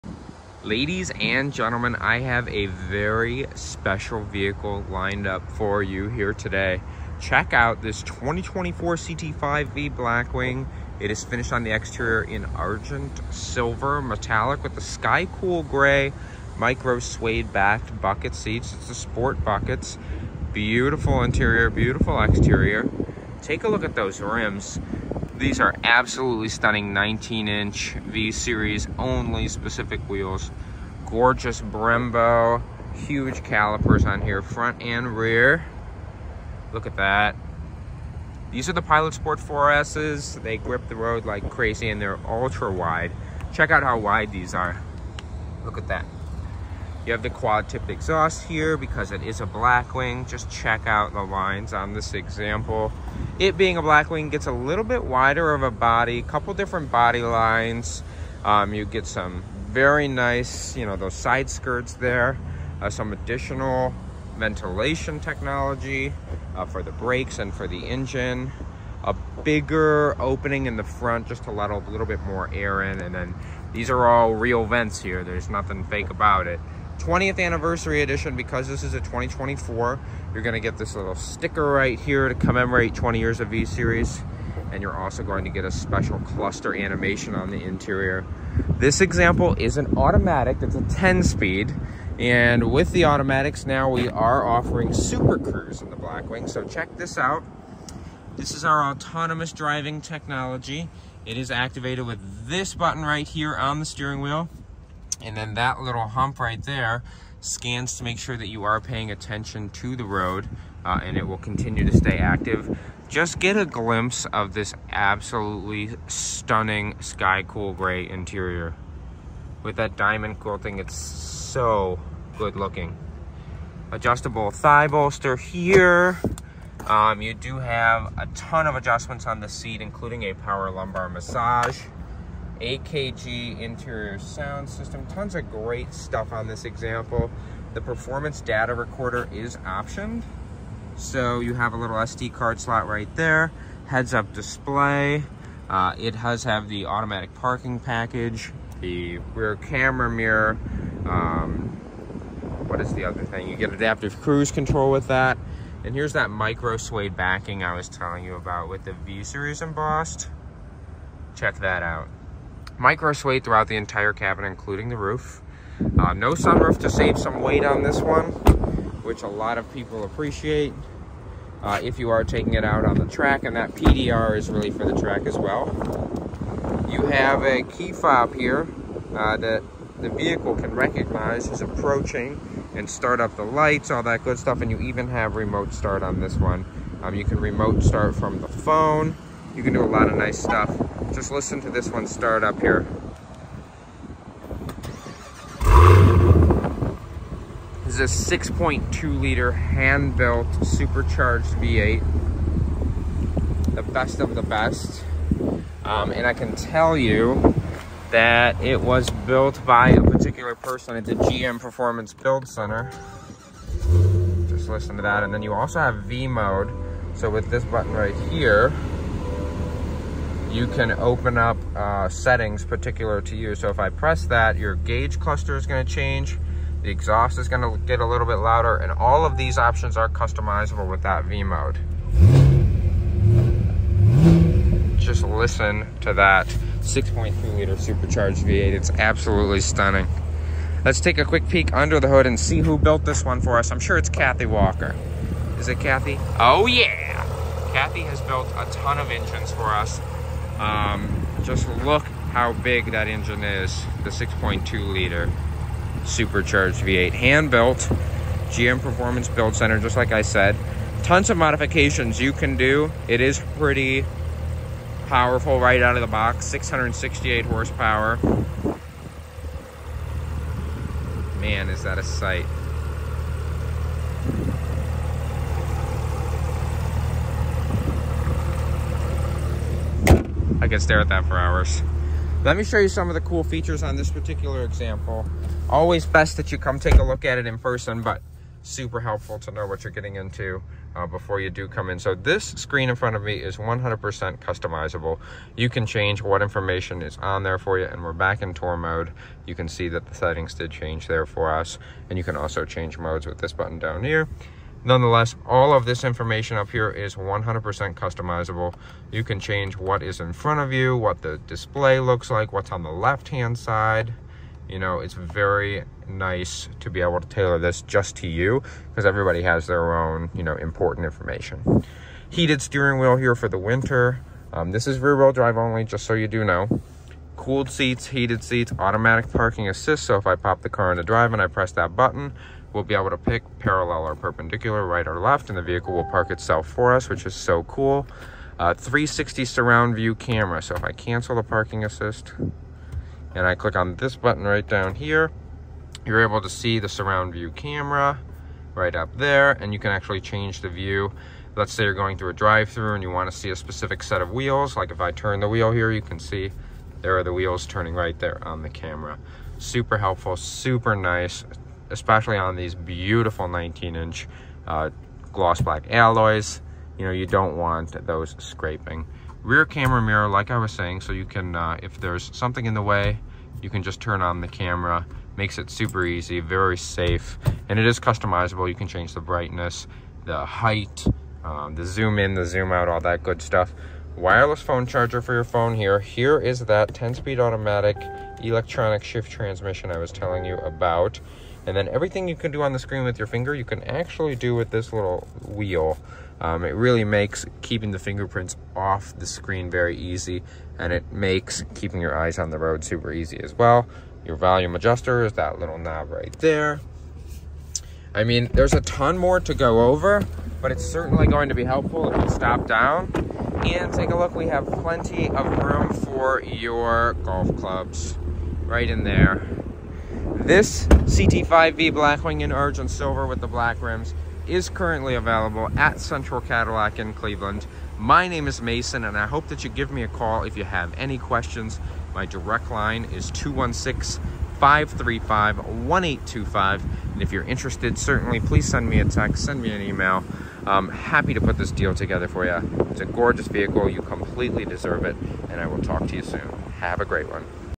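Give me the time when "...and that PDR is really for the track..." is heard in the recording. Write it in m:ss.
2:53.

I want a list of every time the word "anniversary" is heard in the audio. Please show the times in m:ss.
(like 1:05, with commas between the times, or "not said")
1:17.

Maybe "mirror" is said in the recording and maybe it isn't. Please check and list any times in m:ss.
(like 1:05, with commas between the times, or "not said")
2:30, 6:10.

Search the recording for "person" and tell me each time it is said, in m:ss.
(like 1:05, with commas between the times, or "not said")
3:30, 4:47.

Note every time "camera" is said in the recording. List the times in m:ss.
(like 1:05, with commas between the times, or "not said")
2:29, 5:40, 5:47, 5:58, 6:09, 6:14.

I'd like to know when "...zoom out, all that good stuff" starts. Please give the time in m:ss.
6:22.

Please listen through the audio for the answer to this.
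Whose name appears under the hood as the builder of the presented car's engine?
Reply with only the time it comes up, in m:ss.
4:04.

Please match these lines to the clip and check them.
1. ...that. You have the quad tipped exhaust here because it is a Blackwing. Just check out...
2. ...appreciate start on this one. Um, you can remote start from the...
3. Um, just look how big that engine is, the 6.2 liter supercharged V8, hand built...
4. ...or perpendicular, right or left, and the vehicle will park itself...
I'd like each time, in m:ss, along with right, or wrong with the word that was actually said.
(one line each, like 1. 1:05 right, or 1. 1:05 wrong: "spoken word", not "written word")
1. 0:45 right
2. 3:05 wrong: "remote", not "appreciate"
3. 4:10 right
4. 5:34 right.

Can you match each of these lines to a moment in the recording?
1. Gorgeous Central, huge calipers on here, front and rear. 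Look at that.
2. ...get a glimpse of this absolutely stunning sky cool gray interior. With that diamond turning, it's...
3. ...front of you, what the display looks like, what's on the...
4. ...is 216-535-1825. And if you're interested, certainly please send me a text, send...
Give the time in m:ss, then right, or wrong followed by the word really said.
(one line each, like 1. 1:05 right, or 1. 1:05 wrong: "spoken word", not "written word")
1. 0:31 wrong: "Brembo", not "Central"
2. 1:53 wrong: "quilting", not "turning"
3. 5:10 right
4. 7:13 right.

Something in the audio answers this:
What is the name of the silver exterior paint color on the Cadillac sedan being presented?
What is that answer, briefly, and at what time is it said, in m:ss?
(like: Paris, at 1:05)
Argent silver metallic, at 0:12.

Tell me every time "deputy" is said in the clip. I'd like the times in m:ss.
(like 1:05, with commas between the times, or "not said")
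not said.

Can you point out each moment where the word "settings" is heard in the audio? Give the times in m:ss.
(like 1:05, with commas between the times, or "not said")
3:42, 5:00.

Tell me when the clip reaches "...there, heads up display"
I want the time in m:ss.
2:23.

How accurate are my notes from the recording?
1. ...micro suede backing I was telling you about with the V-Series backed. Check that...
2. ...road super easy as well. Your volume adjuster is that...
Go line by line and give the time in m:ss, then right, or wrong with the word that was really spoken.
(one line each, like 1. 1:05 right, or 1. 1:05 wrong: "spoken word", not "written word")
1. 2:36 wrong: "embossed", not "backed"
2. 6:42 right.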